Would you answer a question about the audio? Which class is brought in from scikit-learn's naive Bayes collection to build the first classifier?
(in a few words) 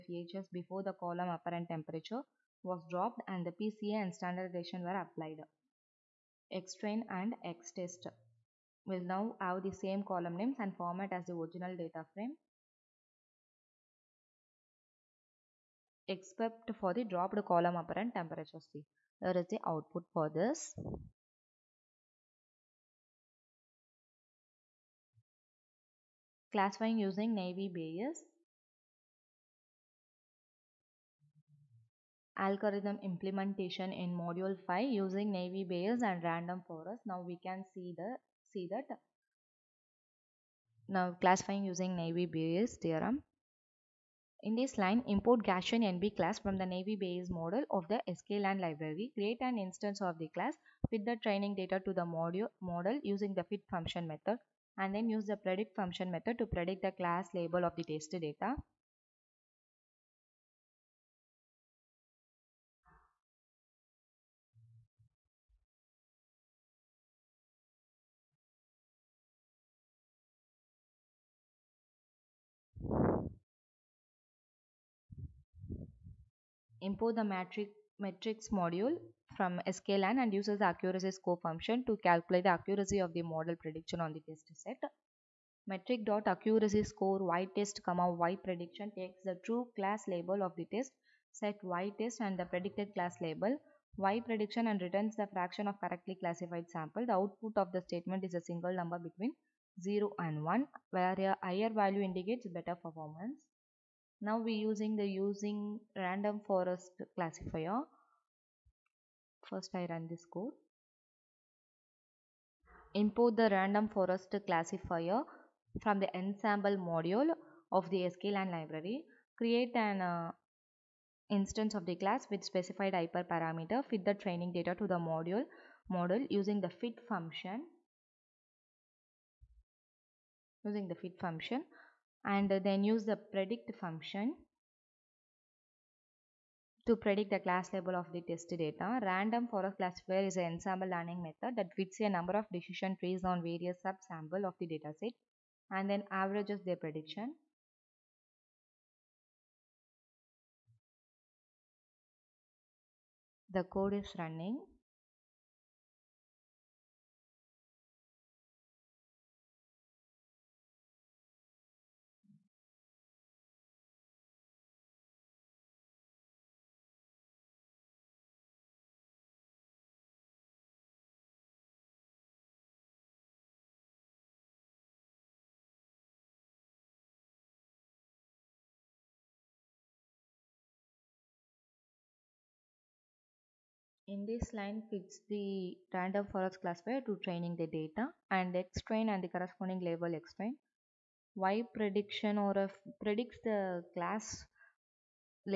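Gaussian NB.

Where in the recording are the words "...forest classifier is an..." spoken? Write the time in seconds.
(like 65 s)
139 s.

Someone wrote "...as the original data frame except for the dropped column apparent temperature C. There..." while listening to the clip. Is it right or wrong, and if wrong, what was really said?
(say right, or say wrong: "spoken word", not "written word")
right.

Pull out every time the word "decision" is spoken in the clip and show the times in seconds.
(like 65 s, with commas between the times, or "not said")
142 s.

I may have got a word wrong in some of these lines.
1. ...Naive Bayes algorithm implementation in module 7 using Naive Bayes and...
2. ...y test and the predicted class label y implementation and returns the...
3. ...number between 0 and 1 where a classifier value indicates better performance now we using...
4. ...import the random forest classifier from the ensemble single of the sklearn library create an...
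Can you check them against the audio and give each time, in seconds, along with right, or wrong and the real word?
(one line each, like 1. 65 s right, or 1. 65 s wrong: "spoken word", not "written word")
1. 27 s wrong: "5", not "7"
2. 91 s wrong: "prediction", not "implementation"
3. 98 s wrong: "higher", not "classifier"
4. 112 s wrong: "module", not "single".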